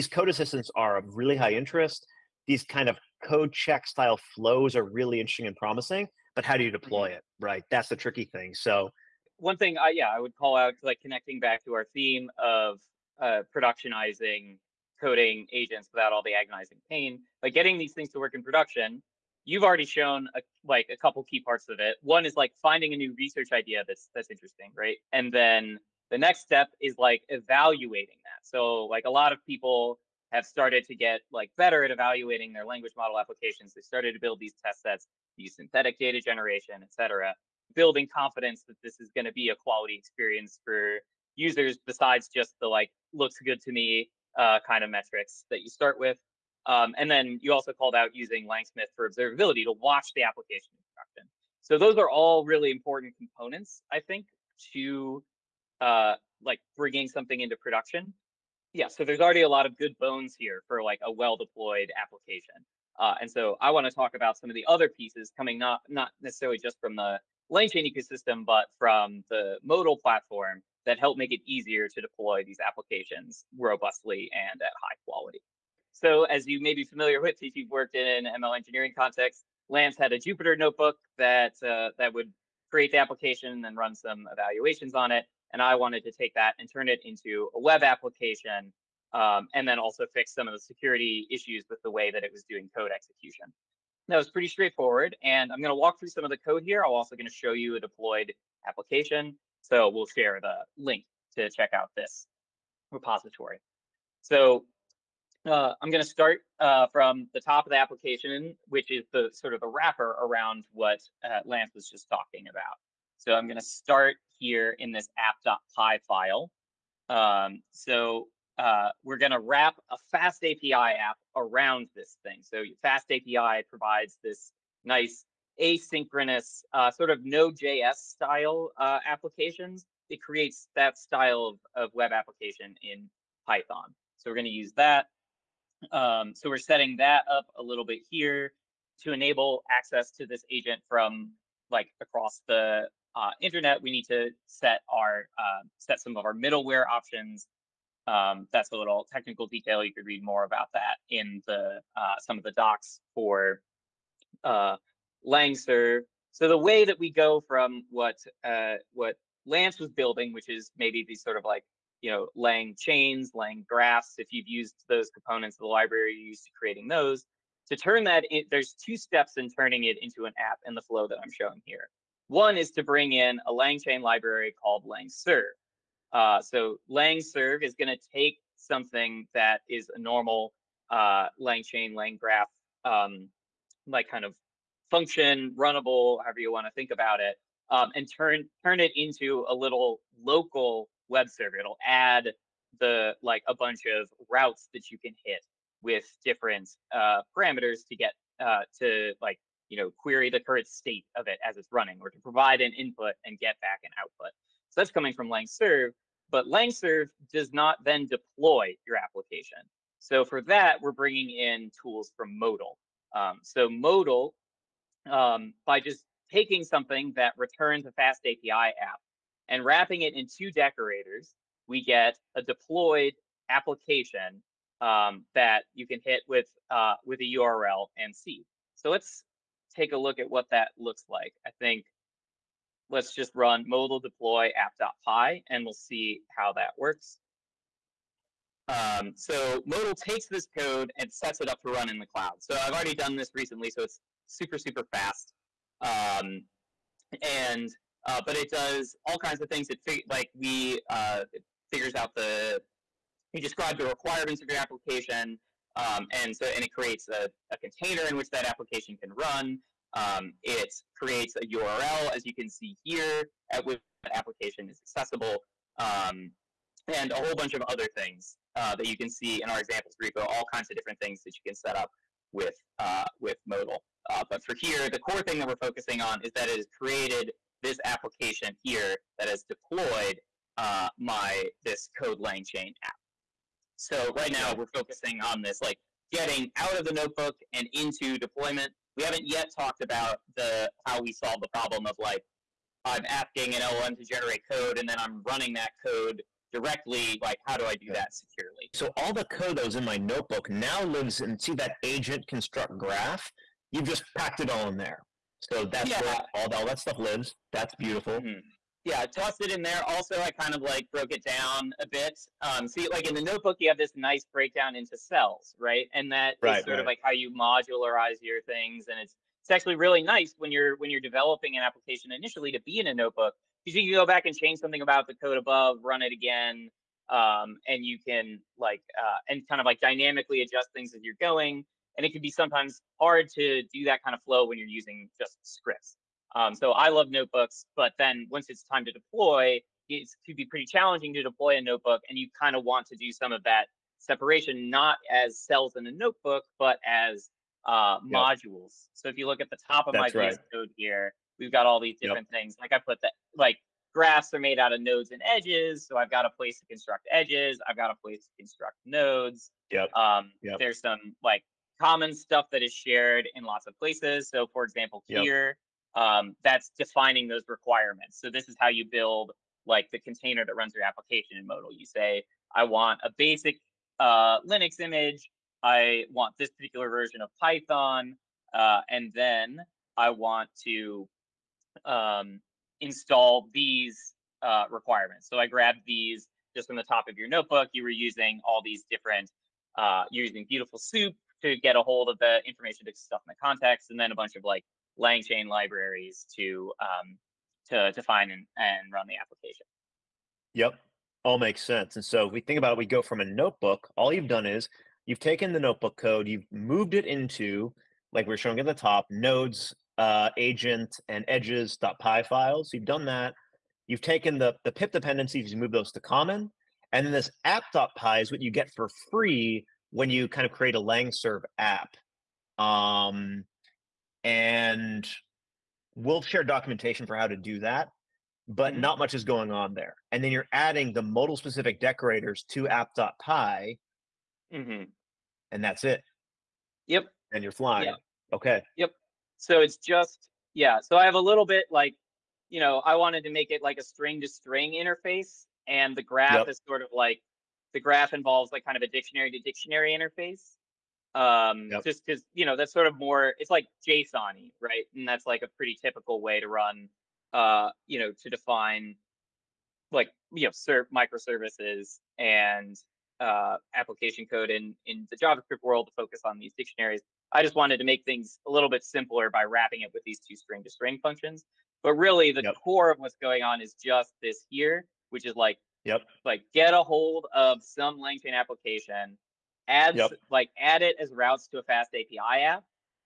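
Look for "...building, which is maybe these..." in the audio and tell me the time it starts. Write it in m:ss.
2:39.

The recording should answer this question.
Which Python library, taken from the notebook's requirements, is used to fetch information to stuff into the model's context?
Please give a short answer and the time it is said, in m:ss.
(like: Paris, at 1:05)
Beautiful Soup, at 6:30.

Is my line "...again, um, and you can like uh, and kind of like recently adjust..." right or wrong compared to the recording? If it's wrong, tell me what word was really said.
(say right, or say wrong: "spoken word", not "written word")
wrong: "dynamically", not "recently".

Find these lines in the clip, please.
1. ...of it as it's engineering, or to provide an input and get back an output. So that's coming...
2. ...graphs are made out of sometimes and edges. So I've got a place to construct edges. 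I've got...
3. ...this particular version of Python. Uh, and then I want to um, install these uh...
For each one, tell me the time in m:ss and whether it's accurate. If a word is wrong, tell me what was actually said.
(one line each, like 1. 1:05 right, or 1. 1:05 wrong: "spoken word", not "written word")
1. 3:21 wrong: "running", not "engineering"
2. 5:53 wrong: "nodes", not "sometimes"
3. 6:16 right.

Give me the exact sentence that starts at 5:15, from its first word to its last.
And that right, is sort right.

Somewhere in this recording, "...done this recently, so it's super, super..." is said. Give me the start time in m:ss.
4:02.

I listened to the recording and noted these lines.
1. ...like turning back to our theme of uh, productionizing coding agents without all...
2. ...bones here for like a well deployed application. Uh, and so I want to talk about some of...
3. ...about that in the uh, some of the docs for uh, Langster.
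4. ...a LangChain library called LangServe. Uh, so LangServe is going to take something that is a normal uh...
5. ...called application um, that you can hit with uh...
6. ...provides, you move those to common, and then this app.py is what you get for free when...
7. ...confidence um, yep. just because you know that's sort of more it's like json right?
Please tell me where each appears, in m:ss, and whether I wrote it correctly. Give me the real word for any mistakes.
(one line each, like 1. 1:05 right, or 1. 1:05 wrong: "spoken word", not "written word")
1. 0:10 wrong: "connecting", not "turning"
2. 0:59 right
3. 2:30 right
4. 2:53 right
5. 3:42 wrong: "deployed", not "called"
6. 6:54 wrong: "dependencies", not "provides"
7. 7:29 wrong: "interface", not "confidence".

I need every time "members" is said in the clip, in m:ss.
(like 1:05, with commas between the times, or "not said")
not said.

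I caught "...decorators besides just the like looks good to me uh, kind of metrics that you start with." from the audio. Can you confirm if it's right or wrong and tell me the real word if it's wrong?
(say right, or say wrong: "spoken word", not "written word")
wrong: "users", not "decorators".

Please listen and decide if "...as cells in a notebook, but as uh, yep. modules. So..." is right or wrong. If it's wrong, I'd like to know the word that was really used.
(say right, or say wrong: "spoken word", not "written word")
right.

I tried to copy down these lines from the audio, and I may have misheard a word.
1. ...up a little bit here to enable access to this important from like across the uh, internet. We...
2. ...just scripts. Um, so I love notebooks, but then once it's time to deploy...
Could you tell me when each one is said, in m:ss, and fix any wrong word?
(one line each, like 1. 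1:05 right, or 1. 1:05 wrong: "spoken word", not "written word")
1. 2:17 wrong: "agent", not "important"
2. 5:35 right.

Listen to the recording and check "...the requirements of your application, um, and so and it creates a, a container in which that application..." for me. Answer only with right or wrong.
right.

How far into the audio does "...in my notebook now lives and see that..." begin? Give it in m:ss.
4:59.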